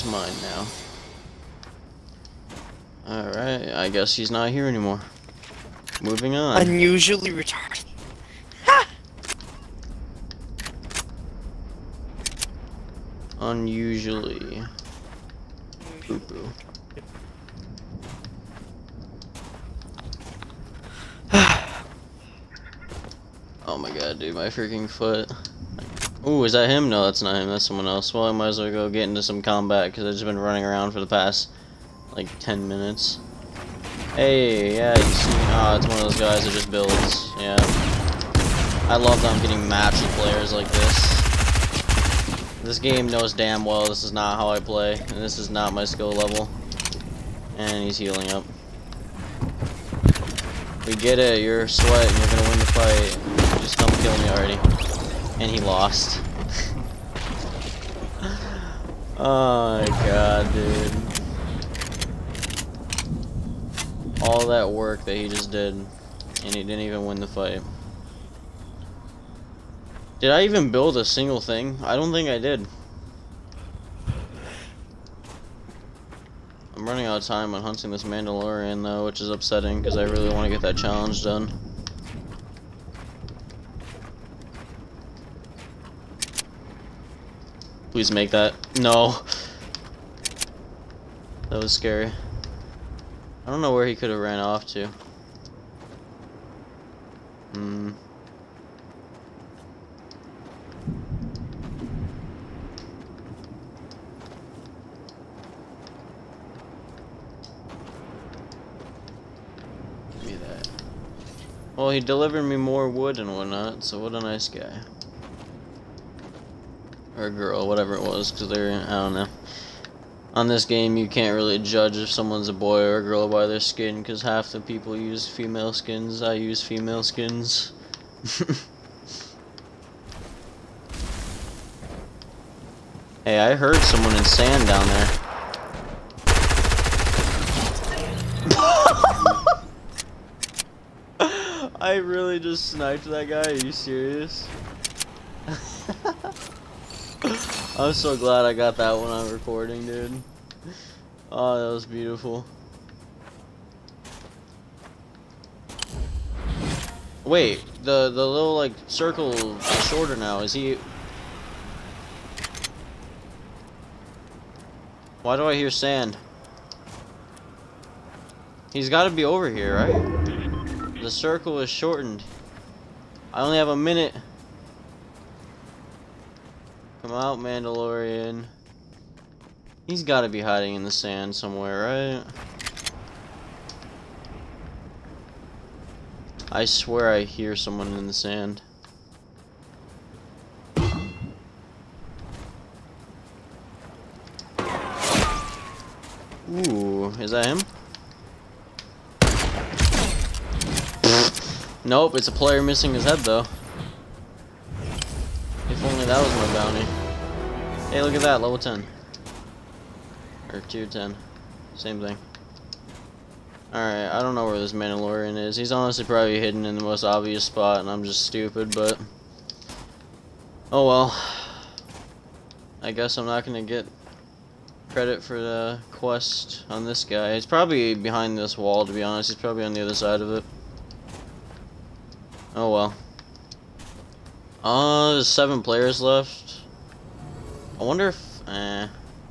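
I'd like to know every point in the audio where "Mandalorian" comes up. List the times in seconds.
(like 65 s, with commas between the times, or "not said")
78 s, 177 s, 214 s.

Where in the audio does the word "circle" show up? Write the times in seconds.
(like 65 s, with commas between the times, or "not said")
158 s, 171 s.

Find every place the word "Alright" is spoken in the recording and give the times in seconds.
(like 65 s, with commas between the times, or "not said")
3 s, 213 s.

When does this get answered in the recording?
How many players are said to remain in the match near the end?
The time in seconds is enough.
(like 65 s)
235 s.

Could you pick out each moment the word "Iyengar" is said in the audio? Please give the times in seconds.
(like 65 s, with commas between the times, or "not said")
not said.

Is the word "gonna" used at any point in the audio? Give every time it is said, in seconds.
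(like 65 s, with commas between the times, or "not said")
52 s, 223 s.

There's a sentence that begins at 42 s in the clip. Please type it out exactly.
This game knows damn well this is not how I play, and this is not my skill level.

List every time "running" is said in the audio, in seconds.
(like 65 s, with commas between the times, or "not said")
30 s, 76 s.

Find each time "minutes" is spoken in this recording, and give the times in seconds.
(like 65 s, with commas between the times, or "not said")
32 s, 173 s.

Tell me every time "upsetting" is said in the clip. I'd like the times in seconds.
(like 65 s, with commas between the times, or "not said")
79 s.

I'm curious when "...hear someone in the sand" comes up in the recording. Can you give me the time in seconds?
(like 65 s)
187 s.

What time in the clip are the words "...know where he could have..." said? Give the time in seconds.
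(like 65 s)
93 s.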